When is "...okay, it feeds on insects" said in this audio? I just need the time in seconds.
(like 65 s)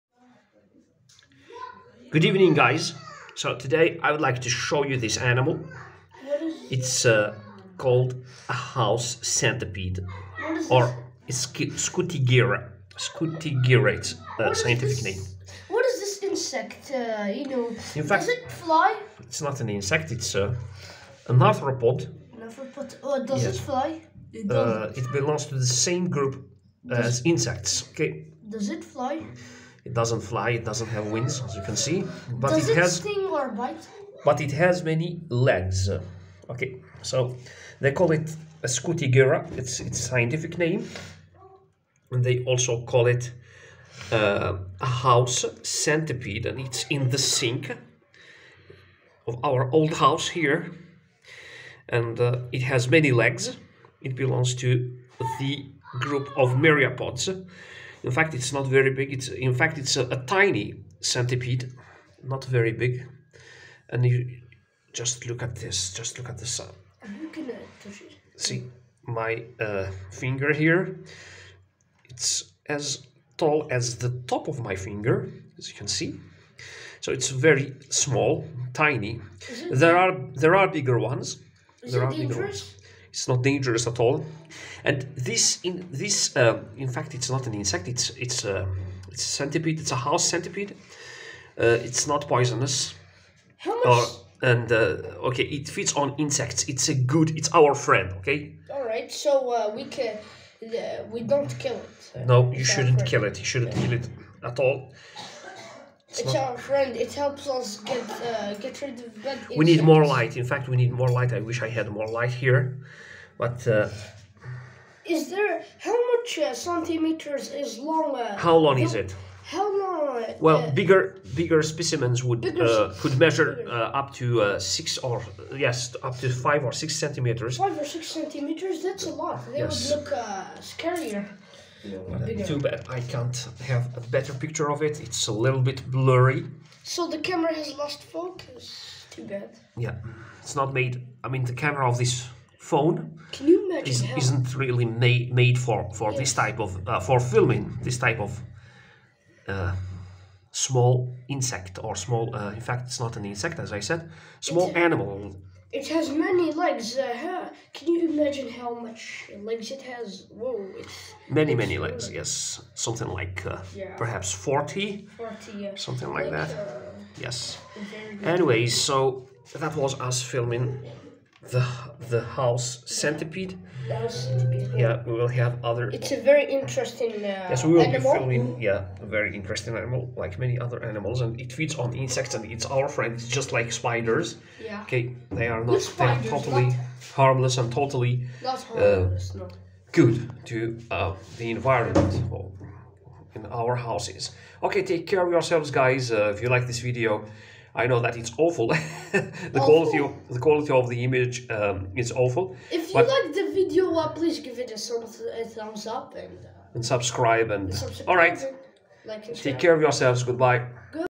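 95 s.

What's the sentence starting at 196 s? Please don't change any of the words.
Uh, if you like this video I know that it's awful.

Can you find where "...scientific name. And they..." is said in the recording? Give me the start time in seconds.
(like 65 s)
39 s.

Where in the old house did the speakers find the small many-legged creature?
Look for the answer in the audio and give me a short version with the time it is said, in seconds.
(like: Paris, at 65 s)
In the sink, at 46 s.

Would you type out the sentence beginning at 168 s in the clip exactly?
Anyway, so that was us filming the the house centipede.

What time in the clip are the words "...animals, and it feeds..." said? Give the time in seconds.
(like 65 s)
180 s.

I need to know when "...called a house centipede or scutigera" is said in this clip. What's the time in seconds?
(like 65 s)
7 s.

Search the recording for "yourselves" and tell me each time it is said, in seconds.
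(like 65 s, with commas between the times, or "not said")
195 s, 209 s.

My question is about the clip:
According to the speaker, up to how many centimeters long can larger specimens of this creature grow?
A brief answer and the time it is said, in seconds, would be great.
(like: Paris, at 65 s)
5 or 6 centimeters, at 126 s.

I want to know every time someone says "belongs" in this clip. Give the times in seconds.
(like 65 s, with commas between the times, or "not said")
25 s, 54 s.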